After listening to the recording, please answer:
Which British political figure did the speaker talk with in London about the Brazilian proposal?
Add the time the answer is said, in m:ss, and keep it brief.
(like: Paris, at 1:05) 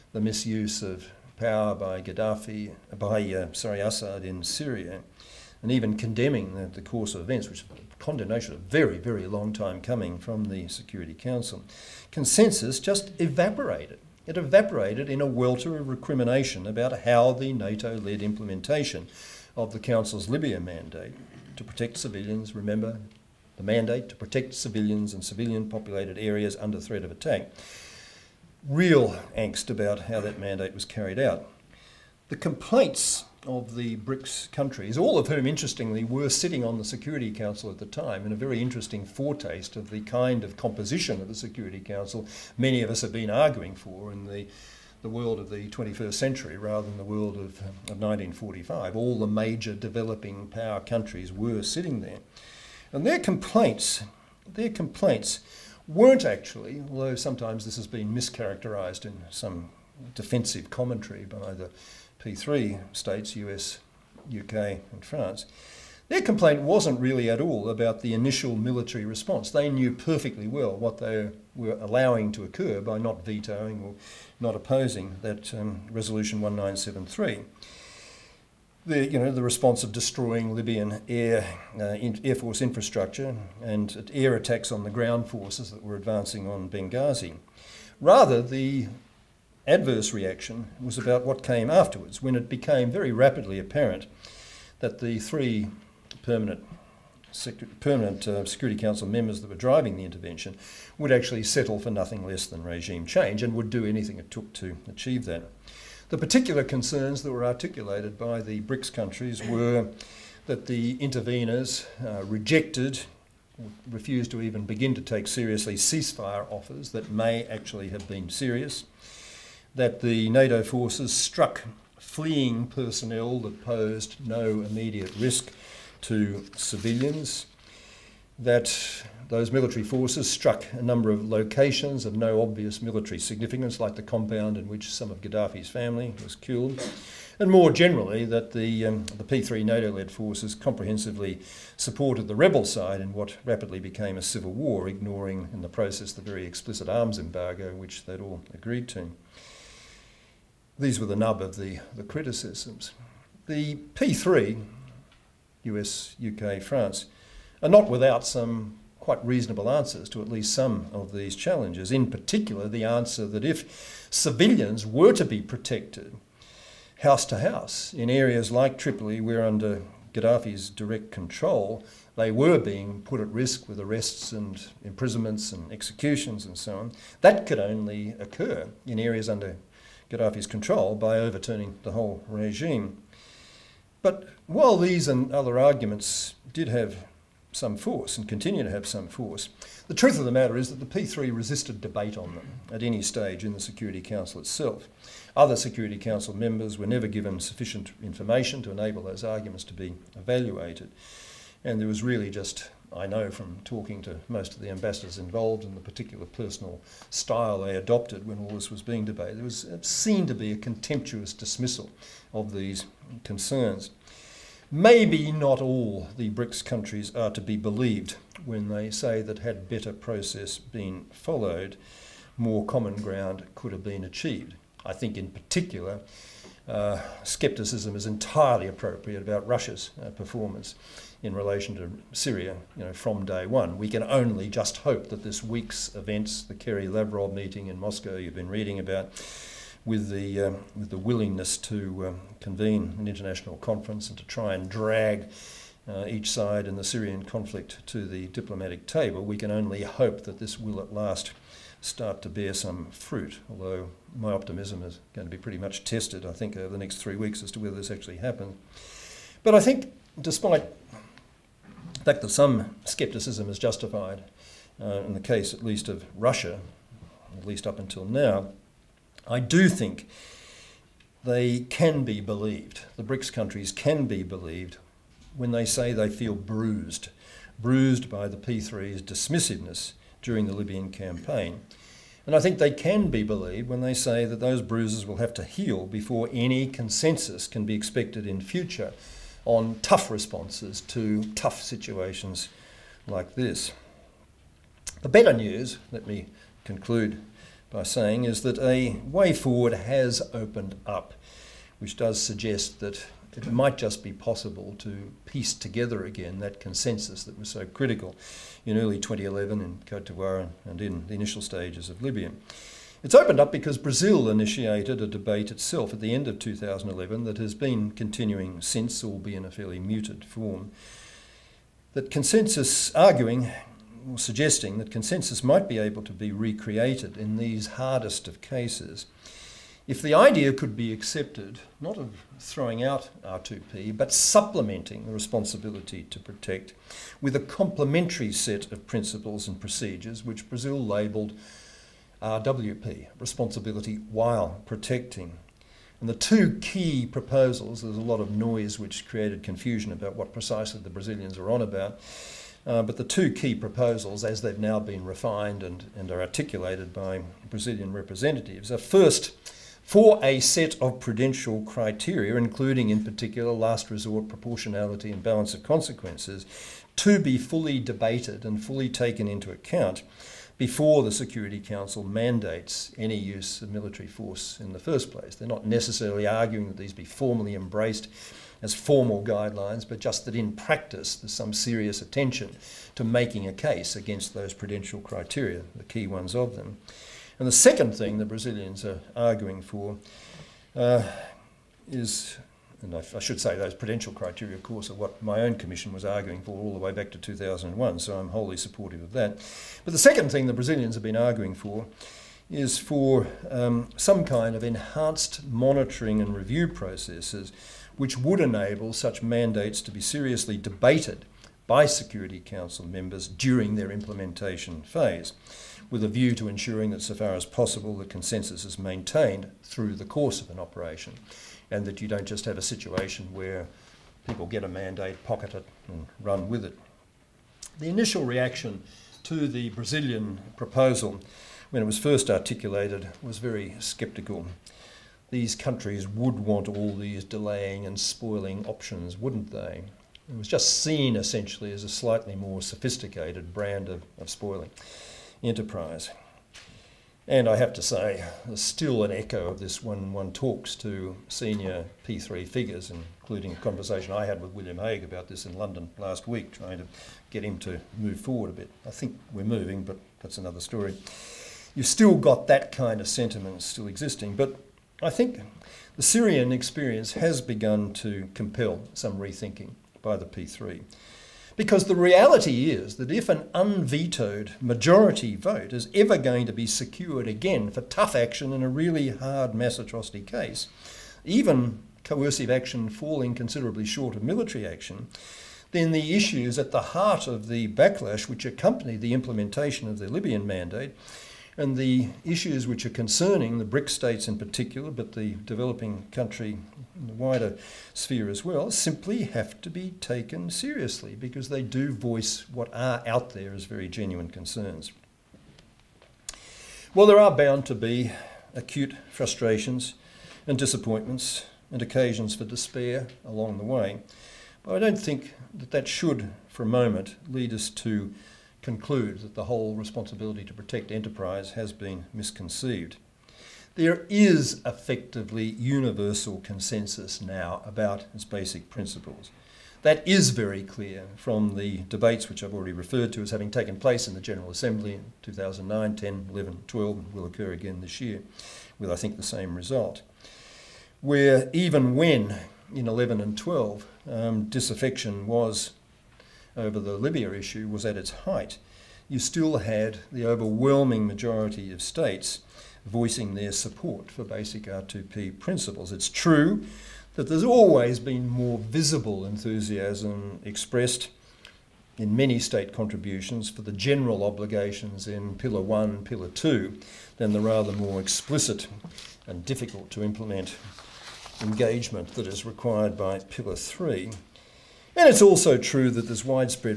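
William Hague, at 7:34.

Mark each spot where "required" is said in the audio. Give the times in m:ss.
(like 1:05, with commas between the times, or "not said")
9:32.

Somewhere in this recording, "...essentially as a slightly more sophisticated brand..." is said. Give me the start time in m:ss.
7:21.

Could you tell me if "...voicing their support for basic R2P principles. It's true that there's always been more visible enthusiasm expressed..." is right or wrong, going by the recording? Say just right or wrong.
right.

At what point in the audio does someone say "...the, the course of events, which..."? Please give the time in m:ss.
0:06.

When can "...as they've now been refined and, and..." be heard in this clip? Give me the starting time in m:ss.
5:54.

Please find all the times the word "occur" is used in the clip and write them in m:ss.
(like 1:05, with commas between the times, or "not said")
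1:12, 2:58, 8:57.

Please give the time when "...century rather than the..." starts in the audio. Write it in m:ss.
0:46.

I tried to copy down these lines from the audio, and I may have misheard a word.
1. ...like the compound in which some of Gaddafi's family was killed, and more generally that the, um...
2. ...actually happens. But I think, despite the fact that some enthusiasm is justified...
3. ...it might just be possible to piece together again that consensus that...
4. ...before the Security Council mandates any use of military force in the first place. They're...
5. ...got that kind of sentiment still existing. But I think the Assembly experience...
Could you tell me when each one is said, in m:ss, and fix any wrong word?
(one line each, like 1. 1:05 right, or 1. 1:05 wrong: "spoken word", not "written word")
1. 2:13 right
2. 4:17 wrong: "scepticism", not "enthusiasm"
3. 5:03 right
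4. 6:10 right
5. 7:42 wrong: "Syrian", not "Assembly".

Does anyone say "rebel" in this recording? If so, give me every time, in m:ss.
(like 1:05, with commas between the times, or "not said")
2:22.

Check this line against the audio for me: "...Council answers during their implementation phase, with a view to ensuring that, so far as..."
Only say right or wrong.
wrong.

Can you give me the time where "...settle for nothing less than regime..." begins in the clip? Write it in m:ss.
1:41.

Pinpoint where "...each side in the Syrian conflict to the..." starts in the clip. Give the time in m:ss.
4:06.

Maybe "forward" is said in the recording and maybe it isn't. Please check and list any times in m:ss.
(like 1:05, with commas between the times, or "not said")
4:59, 7:38.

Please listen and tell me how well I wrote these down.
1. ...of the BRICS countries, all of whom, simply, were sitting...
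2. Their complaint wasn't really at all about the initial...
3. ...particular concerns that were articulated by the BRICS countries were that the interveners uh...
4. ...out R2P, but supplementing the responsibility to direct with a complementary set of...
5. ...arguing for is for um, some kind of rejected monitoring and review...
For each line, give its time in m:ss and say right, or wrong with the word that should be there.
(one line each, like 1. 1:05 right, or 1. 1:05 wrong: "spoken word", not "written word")
1. 0:33 wrong: "interestingly", not "simply"
2. 1:06 right
3. 1:46 right
4. 5:32 wrong: "protect", not "direct"
5. 6:41 wrong: "enhanced", not "rejected".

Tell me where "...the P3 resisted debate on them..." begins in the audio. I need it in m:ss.
3:10.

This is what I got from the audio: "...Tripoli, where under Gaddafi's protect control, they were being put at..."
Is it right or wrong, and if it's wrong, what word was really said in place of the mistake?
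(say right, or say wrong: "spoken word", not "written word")
wrong: "direct", not "protect".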